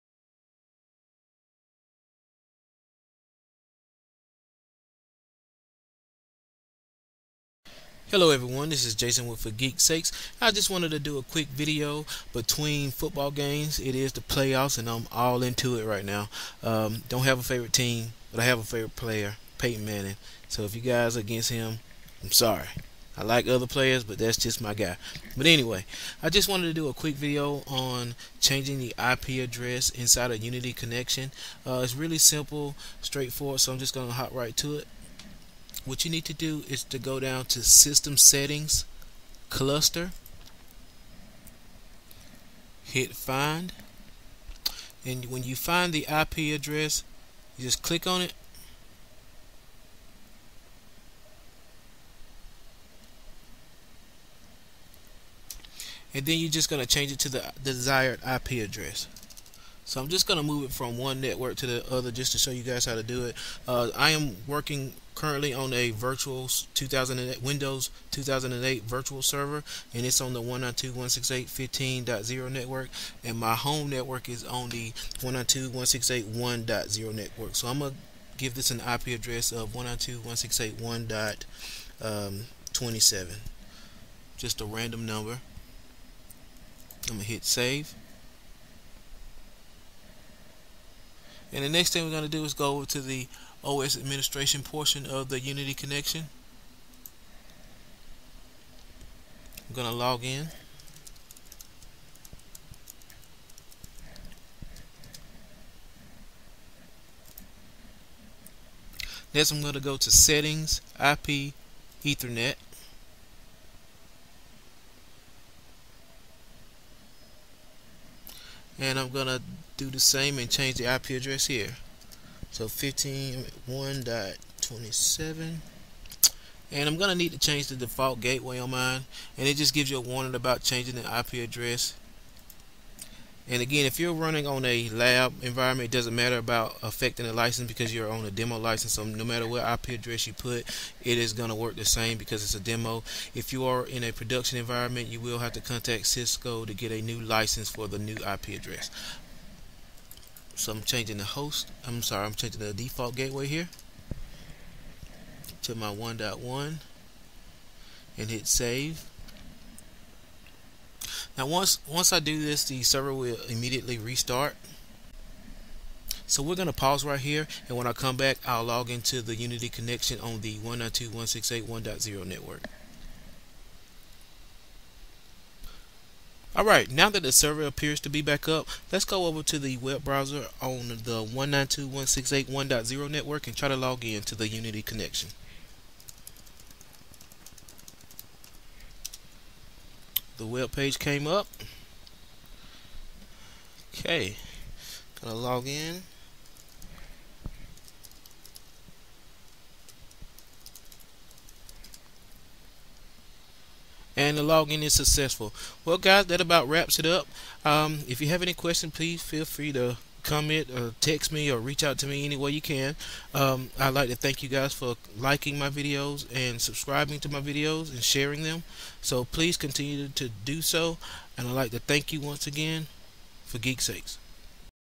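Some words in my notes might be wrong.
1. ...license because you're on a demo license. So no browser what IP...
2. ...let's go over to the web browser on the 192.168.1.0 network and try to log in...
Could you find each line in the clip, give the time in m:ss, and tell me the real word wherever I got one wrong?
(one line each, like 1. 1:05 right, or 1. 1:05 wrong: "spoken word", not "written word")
1. 2:17 wrong: "matter", not "browser"
2. 2:58 right.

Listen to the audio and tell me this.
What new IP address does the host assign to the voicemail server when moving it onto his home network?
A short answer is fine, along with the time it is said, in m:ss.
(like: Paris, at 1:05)
192.168.1.27, at 1:19.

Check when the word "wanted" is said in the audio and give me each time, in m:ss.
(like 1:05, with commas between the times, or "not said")
0:10, 0:26.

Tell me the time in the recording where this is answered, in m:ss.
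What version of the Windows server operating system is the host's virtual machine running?
1:07.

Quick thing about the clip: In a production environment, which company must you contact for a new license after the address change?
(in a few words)
Cisco.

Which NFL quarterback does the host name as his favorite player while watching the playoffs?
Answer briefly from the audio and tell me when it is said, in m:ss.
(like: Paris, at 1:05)
Peyton Manning, at 0:19.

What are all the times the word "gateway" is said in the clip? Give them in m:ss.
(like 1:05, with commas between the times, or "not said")
2:08, 2:33.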